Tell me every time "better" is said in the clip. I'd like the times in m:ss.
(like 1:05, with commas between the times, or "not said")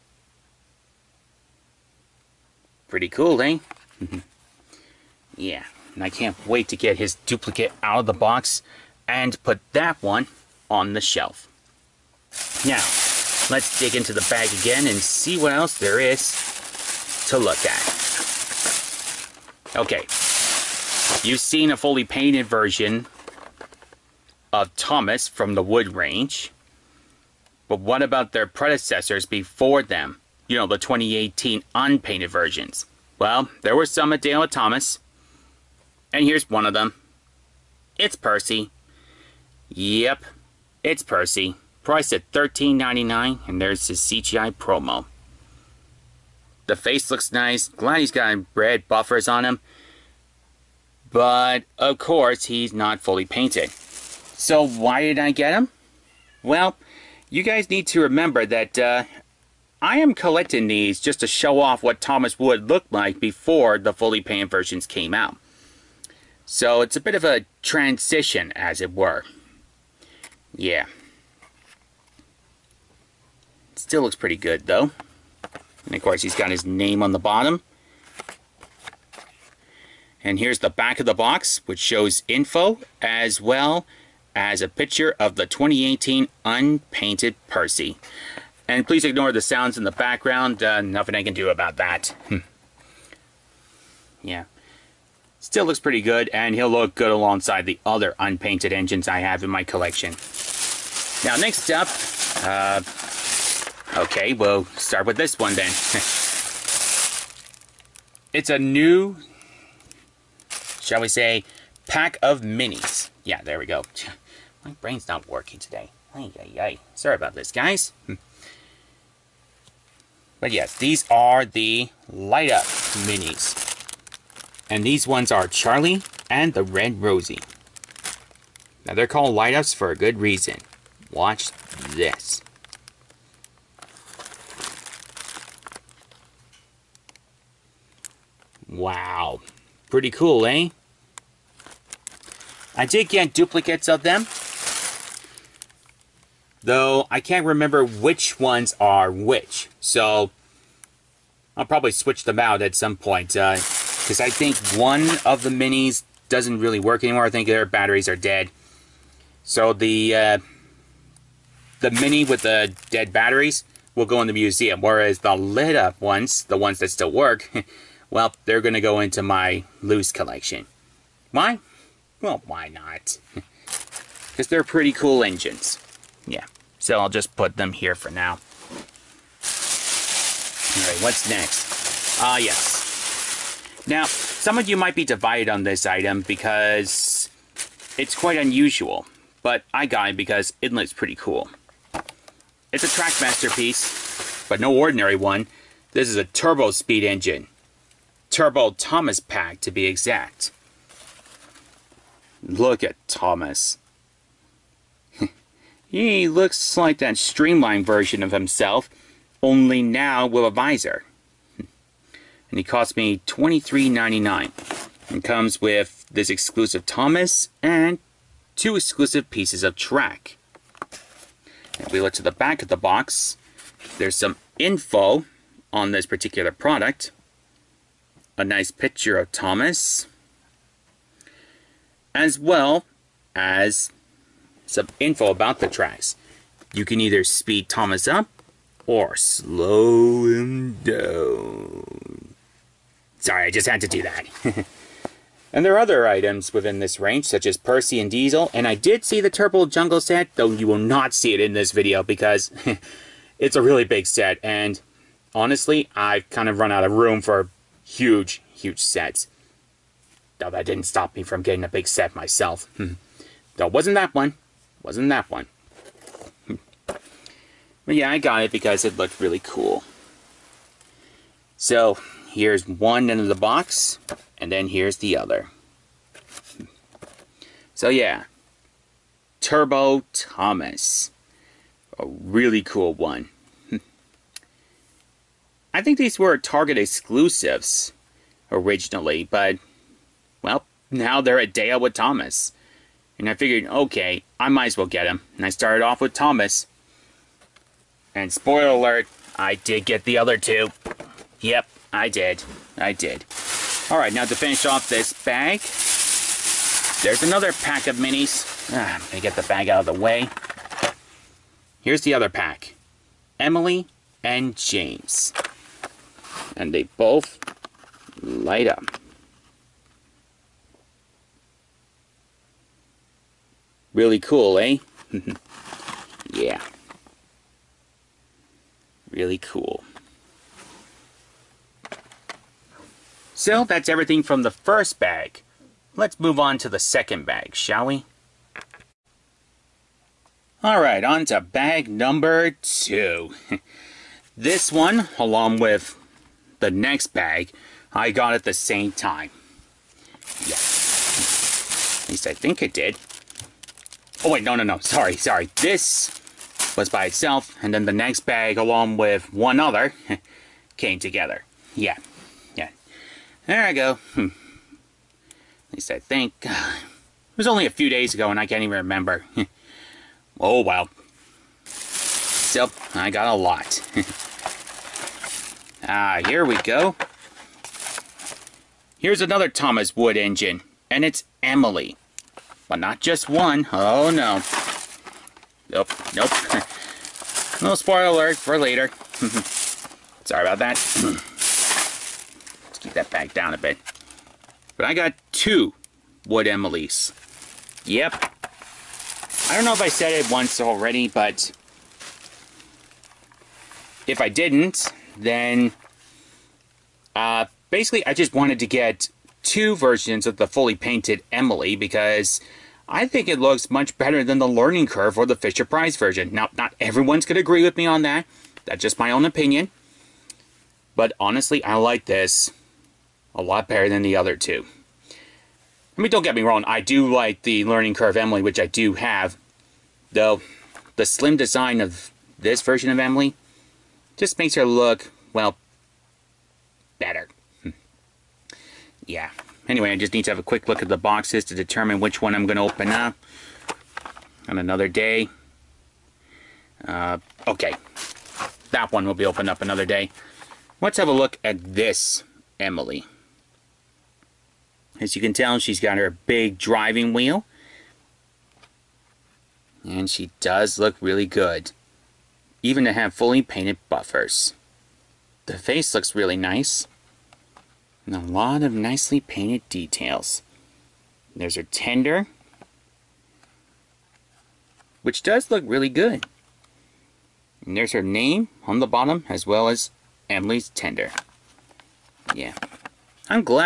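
6:53, 7:03, 7:16.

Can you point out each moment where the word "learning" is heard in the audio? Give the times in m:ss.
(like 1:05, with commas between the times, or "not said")
6:54, 7:07.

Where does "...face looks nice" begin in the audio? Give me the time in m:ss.
0:46.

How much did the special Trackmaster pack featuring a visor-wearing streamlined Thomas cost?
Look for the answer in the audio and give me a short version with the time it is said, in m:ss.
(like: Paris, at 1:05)
$23.99, at 3:33.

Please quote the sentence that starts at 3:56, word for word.
You can either speed Thomas up or slow him down.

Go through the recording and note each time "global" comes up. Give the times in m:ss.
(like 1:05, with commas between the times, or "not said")
not said.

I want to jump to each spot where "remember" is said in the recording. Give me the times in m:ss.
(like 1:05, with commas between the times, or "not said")
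0:58, 2:27, 6:08.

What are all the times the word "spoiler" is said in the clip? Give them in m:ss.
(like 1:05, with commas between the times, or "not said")
4:58, 6:27.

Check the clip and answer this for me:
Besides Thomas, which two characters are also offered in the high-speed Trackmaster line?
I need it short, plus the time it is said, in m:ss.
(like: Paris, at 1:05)
Percy and Diesel, at 4:07.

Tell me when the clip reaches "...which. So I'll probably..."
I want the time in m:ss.
2:29.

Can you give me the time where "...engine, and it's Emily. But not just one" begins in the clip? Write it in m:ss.
6:20.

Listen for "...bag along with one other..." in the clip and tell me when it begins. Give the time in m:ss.
5:58.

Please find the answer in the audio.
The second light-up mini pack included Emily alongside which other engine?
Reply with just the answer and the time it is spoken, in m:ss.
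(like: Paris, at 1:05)
James, at 5:14.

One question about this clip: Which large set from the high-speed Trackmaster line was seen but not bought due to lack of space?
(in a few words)
Turbo Jungle set.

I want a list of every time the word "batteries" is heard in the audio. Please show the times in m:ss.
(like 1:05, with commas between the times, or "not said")
2:37, 2:43.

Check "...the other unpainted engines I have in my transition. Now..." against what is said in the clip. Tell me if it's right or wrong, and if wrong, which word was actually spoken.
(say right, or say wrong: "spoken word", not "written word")
wrong: "collection", not "transition".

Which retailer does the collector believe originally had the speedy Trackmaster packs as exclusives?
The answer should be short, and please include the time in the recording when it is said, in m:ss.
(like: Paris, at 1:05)
Target, at 4:46.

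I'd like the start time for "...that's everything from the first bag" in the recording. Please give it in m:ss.
5:33.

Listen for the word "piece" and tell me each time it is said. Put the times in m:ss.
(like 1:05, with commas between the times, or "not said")
3:13, 3:39.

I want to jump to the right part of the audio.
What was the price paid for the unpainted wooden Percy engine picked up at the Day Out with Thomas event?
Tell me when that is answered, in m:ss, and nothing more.
0:42.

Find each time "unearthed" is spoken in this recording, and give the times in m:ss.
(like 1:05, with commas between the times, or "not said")
not said.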